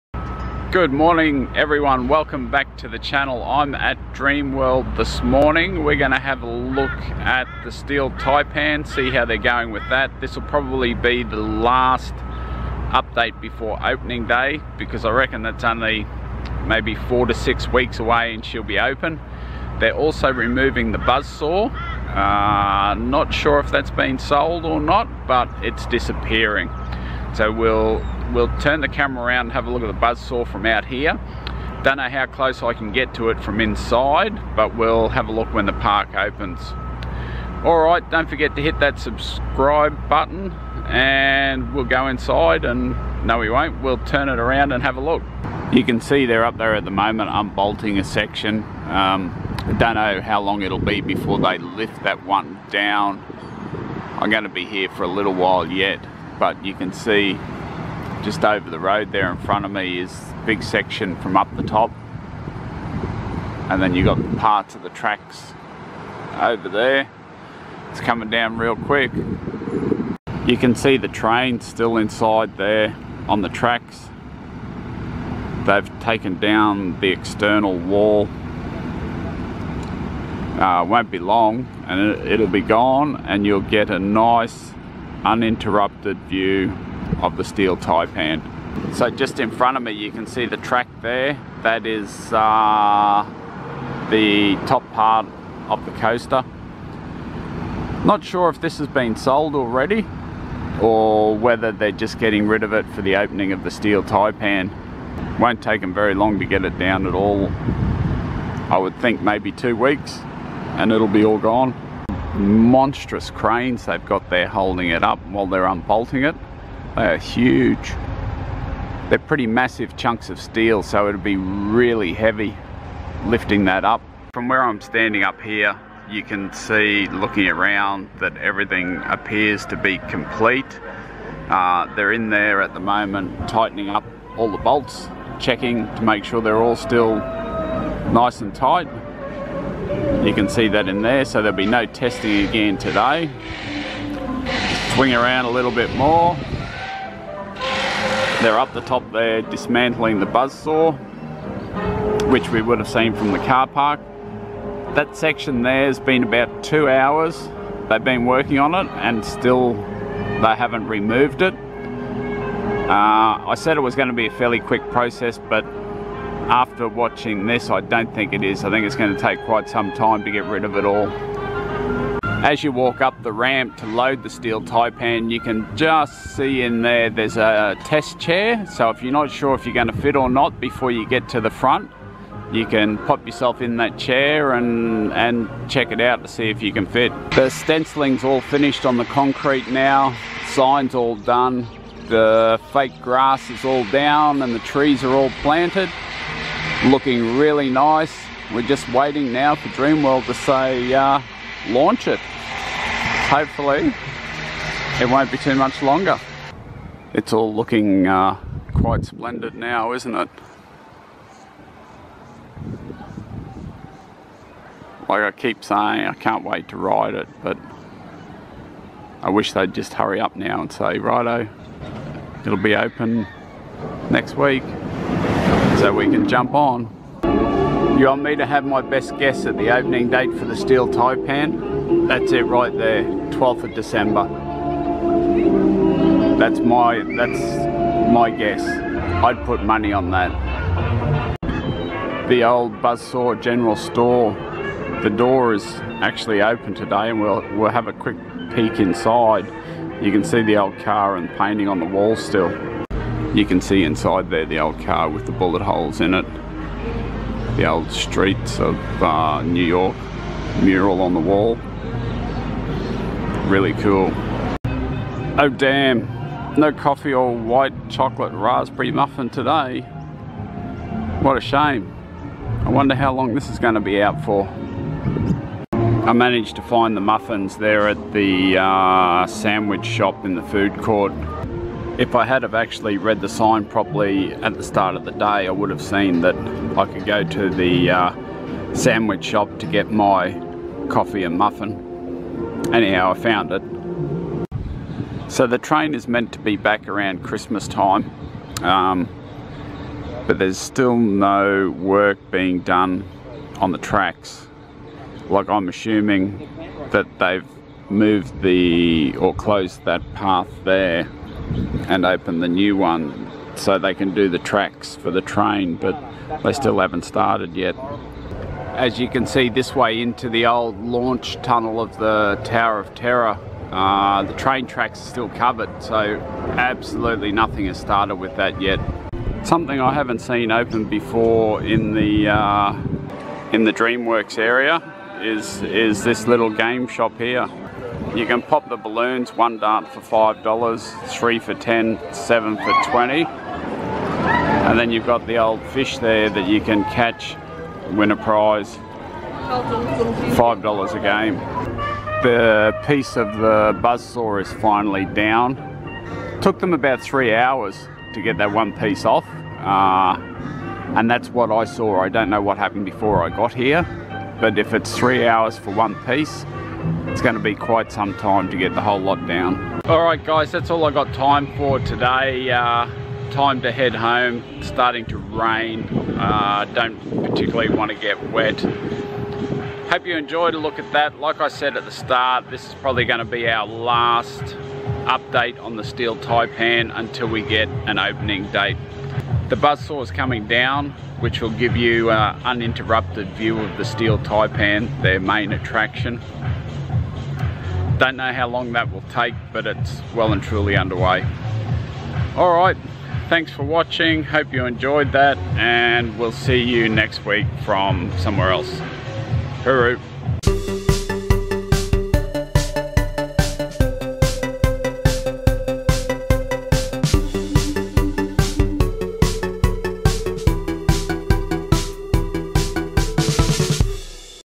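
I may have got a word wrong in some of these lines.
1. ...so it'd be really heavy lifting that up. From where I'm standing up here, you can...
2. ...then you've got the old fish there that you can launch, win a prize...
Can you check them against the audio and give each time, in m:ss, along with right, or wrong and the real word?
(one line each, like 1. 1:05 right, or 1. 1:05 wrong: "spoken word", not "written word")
1. 2:00 right
2. 5:44 wrong: "catch", not "launch".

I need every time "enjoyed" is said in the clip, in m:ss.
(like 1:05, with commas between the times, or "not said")
6:20, 6:44.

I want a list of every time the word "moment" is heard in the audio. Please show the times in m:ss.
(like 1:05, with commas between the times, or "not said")
0:46, 2:12.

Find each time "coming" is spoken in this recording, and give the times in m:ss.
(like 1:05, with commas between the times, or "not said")
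1:07, 6:30.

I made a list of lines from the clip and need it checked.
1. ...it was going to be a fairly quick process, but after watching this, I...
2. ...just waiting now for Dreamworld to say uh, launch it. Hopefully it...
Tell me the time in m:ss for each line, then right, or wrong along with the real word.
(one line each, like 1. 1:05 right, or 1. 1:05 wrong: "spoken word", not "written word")
1. 2:43 right
2. 3:18 right.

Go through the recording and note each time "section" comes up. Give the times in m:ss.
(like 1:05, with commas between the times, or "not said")
0:48, 1:00, 2:35.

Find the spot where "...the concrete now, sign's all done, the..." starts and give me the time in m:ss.
3:08.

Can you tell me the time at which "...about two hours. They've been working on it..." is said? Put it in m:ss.
2:36.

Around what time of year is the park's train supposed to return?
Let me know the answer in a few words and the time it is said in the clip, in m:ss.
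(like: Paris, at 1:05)
Christmas, at 4:57.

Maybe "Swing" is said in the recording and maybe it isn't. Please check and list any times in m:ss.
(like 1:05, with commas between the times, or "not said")
2:24.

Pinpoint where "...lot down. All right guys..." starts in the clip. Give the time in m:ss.
6:08.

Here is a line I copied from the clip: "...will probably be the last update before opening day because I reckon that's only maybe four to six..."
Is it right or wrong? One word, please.
right.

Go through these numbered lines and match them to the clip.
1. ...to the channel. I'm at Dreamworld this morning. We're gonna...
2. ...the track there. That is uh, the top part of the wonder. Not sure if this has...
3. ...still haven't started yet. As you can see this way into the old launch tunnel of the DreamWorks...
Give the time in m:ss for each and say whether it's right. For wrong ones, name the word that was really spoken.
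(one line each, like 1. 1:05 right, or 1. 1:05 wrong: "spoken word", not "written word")
1. 0:02 right
2. 1:30 wrong: "coaster", not "wonder"
3. 5:16 wrong: "Tower", not "DreamWorks".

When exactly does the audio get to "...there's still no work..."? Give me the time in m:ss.
5:00.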